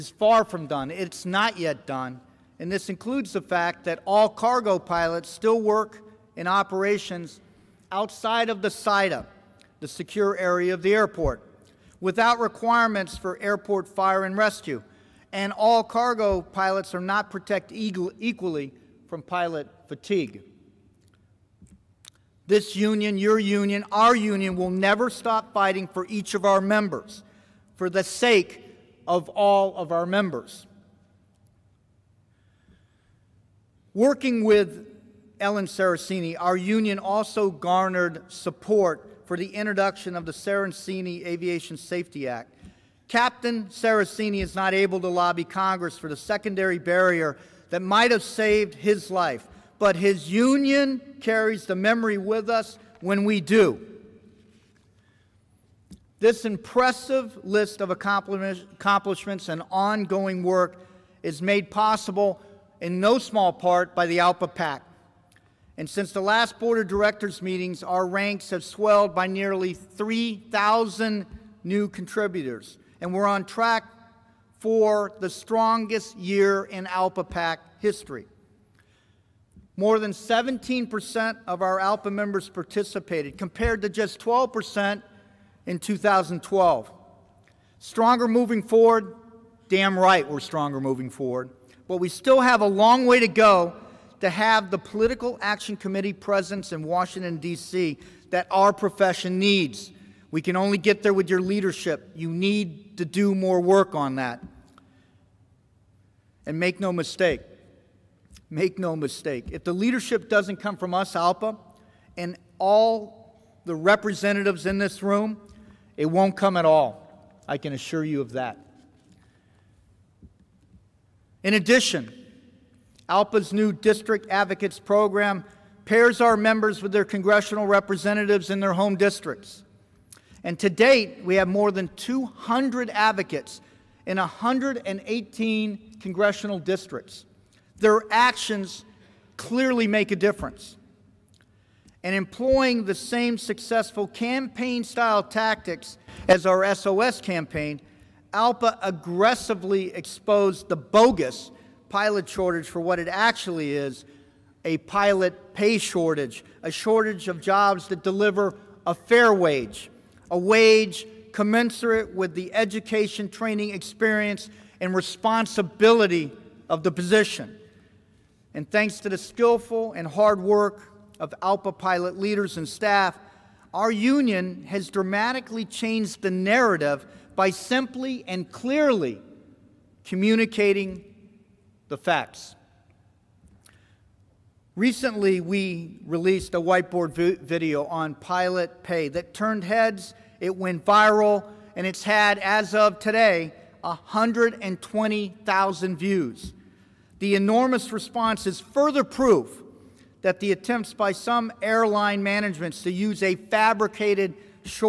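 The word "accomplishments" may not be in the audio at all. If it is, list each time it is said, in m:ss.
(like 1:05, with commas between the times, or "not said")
0:57.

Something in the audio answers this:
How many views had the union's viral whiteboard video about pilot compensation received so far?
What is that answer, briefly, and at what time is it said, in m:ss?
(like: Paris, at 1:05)
120,000, at 3:13.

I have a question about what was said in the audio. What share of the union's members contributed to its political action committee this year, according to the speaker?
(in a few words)
17%.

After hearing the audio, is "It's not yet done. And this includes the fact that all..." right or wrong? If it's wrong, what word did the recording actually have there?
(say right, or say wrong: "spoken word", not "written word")
right.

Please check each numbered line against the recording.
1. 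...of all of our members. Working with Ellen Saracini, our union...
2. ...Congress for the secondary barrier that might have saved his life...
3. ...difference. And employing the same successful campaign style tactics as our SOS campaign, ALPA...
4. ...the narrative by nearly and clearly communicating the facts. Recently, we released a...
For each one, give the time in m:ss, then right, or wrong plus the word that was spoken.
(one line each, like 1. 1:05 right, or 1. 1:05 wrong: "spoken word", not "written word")
1. 0:29 right
2. 0:45 right
3. 2:20 right
4. 2:56 wrong: "simply", not "nearly".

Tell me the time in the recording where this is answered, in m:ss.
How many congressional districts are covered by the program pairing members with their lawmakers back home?
2:14.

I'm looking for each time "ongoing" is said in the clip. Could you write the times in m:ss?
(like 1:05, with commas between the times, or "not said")
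0:59.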